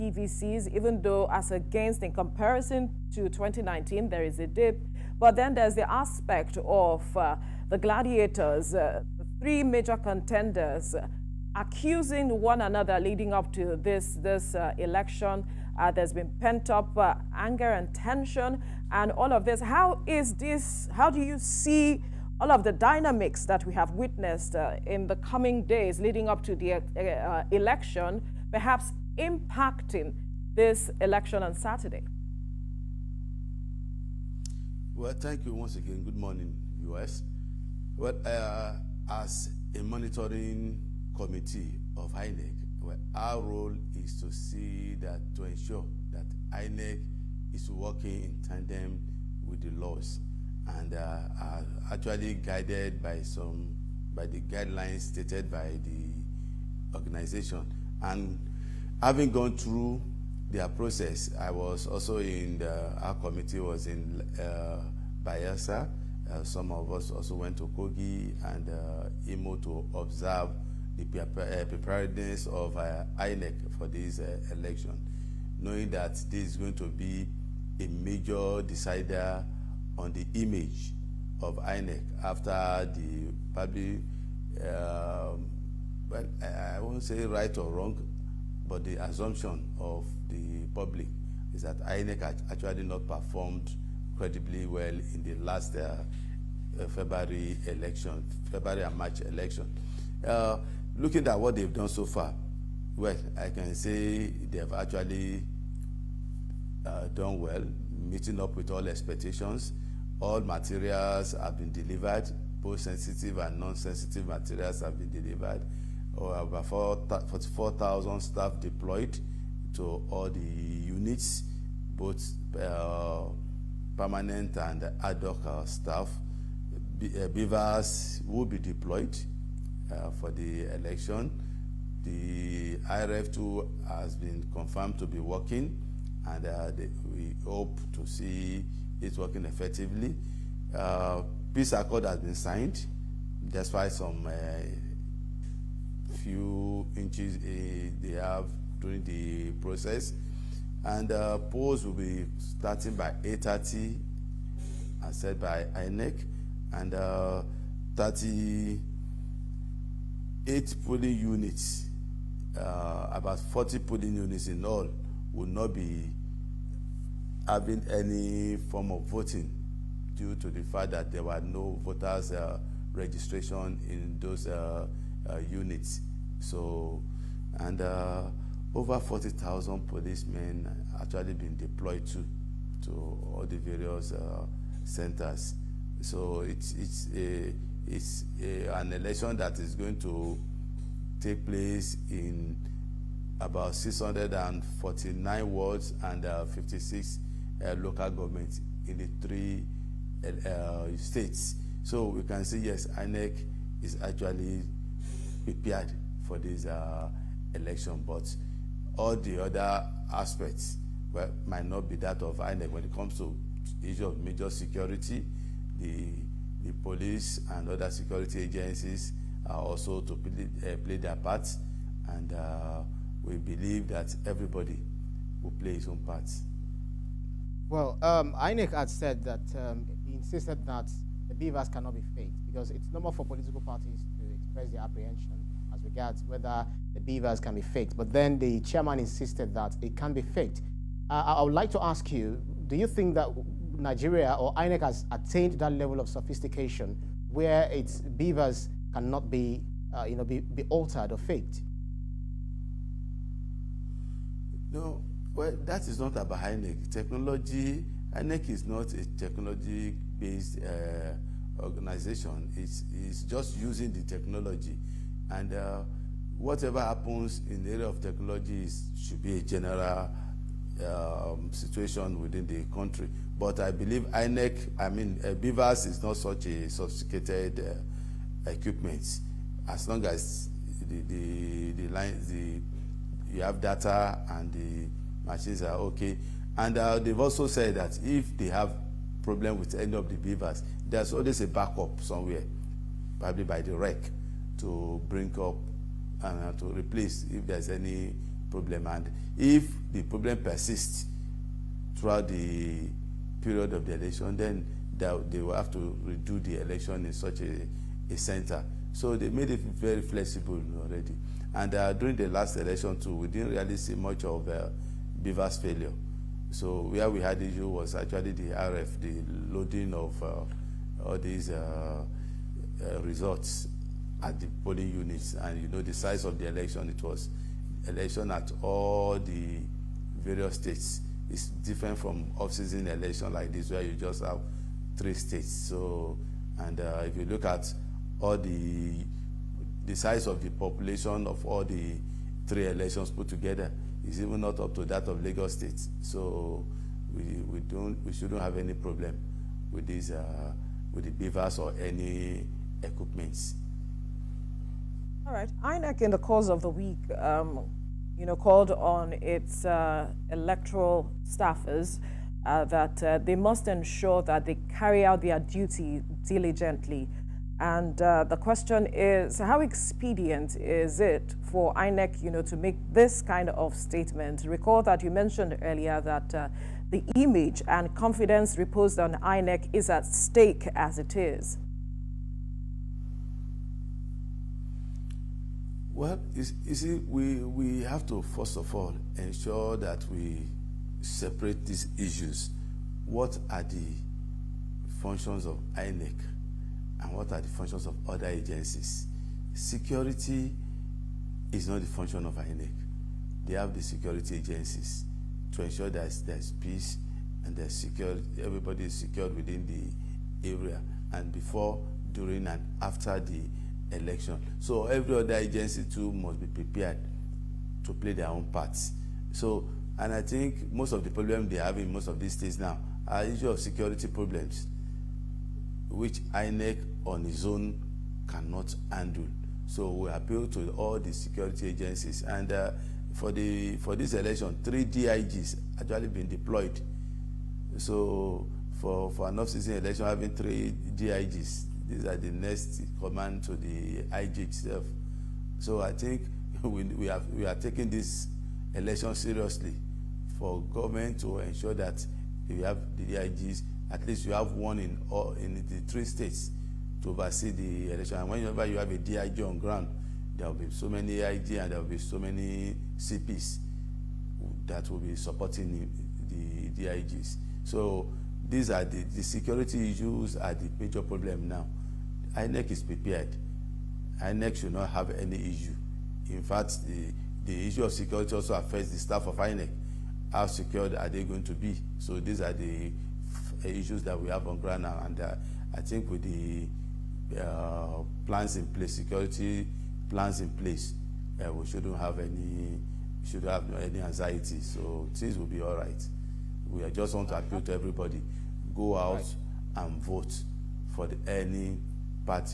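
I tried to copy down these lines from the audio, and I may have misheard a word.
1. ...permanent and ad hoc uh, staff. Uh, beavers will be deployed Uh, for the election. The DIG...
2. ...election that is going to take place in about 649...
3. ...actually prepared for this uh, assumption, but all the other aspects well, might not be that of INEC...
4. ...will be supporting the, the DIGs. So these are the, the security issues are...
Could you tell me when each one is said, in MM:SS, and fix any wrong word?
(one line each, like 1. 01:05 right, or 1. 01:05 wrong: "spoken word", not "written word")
1. 02:03 wrong: "IReV", not "DIG"
2. 03:08 right
3. 03:24 wrong: "election", not "assumption"
4. 07:44 right.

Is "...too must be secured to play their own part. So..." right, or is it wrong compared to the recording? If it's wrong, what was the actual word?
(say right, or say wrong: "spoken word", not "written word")
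wrong: "prepared", not "secured".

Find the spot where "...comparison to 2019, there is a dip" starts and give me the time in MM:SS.
00:02.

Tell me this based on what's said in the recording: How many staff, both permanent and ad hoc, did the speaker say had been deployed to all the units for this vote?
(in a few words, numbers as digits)
Over 44,000.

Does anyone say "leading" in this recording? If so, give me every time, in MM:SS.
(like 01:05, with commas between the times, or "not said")
00:12, 00:25.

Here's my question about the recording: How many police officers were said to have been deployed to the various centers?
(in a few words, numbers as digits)
Over 40,000.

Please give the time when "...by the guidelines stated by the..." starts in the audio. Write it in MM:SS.
00:54.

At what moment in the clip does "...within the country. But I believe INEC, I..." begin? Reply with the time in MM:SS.
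04:32.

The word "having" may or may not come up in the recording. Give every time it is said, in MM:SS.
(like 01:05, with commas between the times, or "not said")
00:59, 02:47, 07:20.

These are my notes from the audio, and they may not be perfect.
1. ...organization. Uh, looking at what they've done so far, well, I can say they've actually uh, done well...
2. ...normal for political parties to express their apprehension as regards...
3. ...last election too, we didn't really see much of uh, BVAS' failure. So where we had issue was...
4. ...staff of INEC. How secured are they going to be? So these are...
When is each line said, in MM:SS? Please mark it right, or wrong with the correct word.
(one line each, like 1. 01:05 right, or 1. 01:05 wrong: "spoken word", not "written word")
1. 01:39 wrong: "election", not "organization"
2. 03:52 right
3. 05:12 right
4. 07:58 right.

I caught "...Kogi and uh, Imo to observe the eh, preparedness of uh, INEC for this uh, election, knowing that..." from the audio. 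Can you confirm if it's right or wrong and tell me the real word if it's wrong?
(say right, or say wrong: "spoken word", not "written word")
right.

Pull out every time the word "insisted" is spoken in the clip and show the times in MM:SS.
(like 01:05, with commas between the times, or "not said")
03:50, 03:58.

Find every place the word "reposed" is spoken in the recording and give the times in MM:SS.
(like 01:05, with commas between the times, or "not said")
06:18.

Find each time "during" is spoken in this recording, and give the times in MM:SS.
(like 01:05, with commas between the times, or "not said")
02:28, 05:11, 06:52.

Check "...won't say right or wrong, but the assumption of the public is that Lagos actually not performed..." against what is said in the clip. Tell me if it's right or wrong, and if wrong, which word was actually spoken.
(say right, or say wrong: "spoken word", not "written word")
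wrong: "INEC", not "Lagos".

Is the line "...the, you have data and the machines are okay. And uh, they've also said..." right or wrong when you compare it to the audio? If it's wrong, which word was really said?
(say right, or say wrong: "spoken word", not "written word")
right.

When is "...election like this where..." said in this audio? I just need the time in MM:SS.
05:32.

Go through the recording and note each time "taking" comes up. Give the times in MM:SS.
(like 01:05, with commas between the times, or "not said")
07:27.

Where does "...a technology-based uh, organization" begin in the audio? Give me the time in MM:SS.
04:18.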